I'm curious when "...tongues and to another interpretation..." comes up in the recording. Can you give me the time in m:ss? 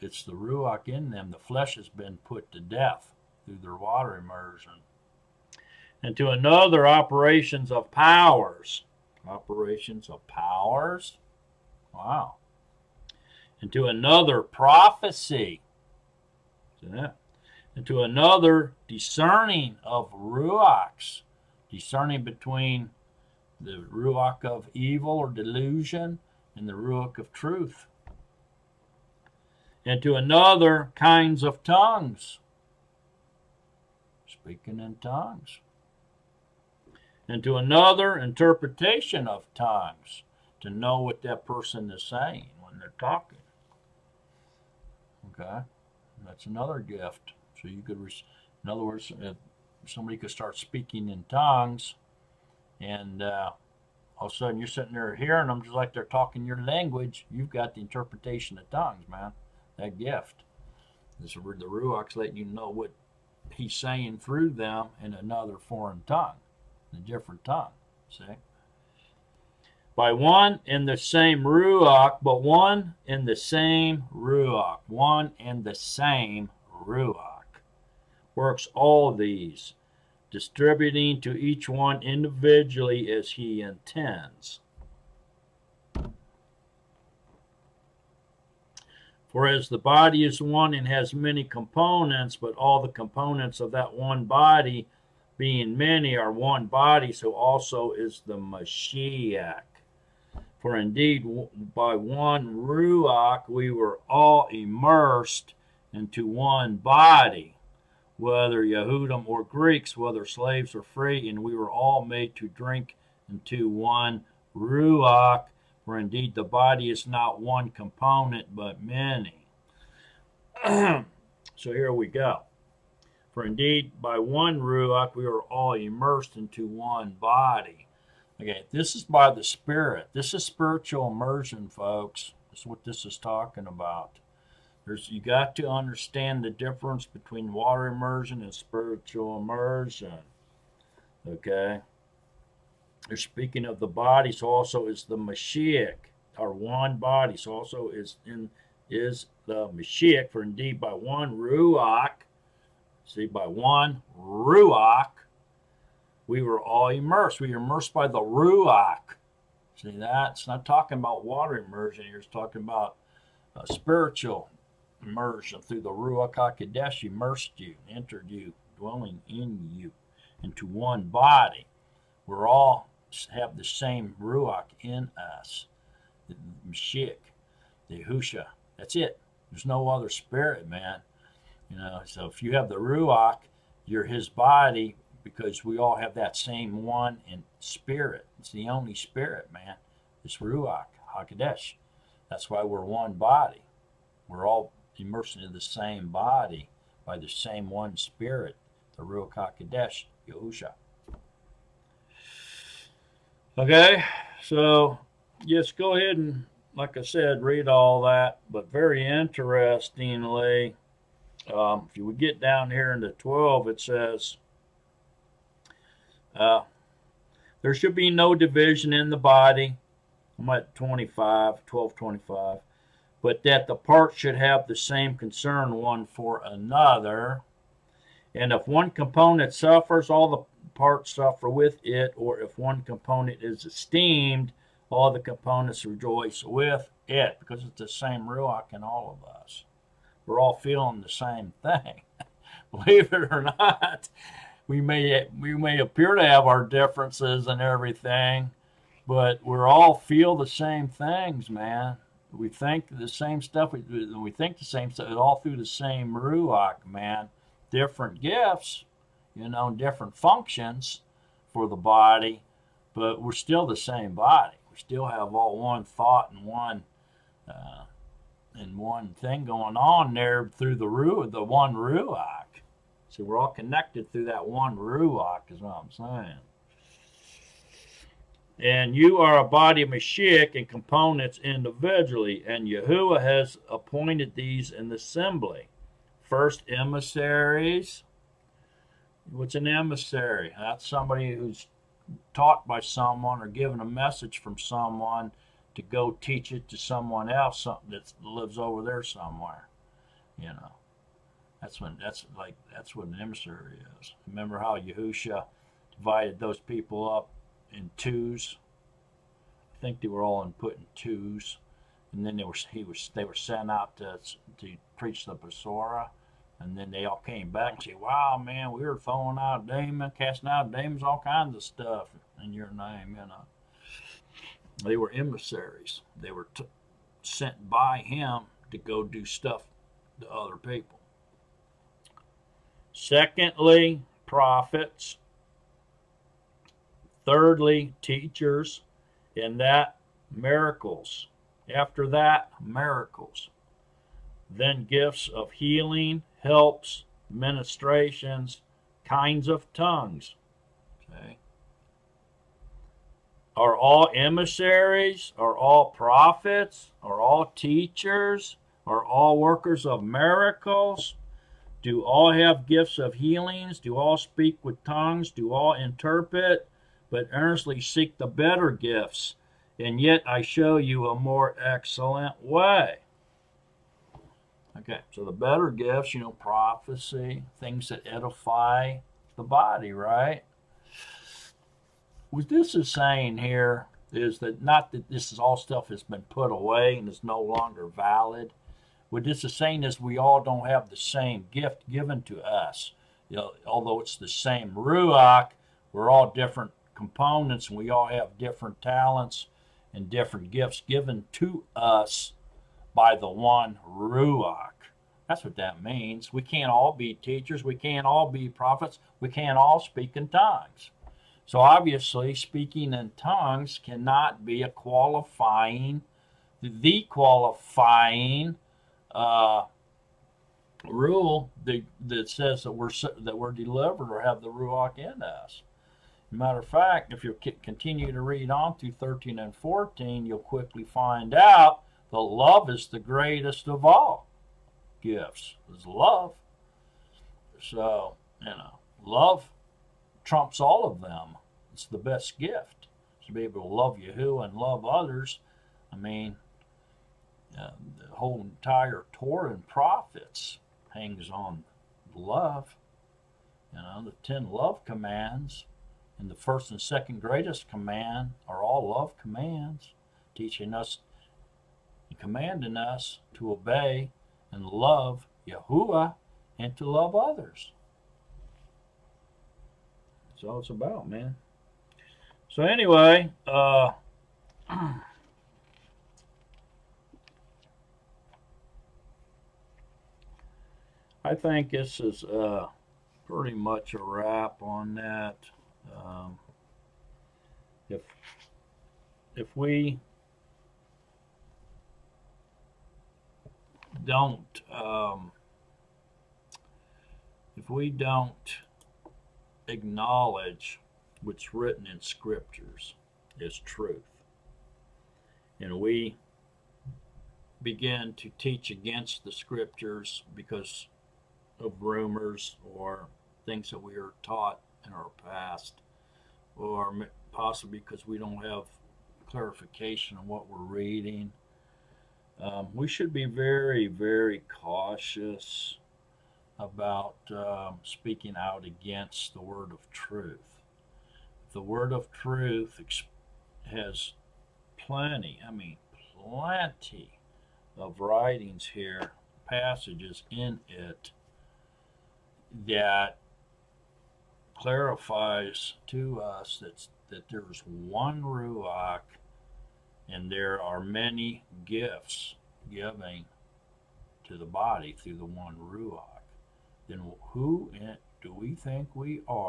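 0:35.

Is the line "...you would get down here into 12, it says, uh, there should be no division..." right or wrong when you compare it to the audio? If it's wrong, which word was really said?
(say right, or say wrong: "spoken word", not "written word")
right.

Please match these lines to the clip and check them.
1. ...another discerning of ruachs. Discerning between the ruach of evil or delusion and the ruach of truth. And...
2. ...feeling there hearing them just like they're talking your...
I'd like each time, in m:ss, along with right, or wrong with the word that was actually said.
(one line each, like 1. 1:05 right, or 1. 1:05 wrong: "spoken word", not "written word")
1. 0:18 right
2. 0:54 wrong: "sitting", not "feeling".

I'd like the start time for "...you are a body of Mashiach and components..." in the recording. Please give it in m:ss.
4:38.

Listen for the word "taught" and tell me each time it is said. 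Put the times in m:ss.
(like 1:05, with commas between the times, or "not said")
4:52, 8:34.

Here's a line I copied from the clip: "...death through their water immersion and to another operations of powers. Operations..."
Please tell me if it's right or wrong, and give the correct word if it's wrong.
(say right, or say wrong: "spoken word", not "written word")
right.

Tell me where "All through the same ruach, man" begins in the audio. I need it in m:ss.
4:15.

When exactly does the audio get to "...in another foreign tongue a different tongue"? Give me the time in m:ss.
1:05.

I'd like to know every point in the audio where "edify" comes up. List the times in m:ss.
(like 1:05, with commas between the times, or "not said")
6:18.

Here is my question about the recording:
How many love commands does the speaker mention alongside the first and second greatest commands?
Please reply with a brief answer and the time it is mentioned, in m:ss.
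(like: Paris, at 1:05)
10, at 7:34.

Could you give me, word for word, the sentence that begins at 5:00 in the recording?
You know, that's when that's like that's what an emissary is.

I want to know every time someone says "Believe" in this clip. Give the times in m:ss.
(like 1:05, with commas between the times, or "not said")
4:02.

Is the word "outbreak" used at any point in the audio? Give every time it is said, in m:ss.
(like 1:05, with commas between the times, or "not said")
not said.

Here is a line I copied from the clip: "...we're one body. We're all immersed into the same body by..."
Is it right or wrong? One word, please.
right.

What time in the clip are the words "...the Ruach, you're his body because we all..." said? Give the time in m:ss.
3:02.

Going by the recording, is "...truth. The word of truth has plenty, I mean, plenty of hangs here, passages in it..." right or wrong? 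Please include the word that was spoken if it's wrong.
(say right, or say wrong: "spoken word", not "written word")
wrong: "writings", not "hangs".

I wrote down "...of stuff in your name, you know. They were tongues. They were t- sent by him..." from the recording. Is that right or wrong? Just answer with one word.
wrong.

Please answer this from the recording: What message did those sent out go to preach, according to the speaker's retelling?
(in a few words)
The Besorah.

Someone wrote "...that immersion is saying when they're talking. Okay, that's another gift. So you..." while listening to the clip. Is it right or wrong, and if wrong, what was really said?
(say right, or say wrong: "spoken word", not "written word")
wrong: "person", not "immersion".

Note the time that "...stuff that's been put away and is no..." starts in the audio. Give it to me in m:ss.
6:25.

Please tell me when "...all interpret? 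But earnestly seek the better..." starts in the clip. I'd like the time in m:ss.
6:05.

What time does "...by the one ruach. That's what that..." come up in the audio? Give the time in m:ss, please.
6:42.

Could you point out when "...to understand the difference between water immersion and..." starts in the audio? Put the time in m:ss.
2:15.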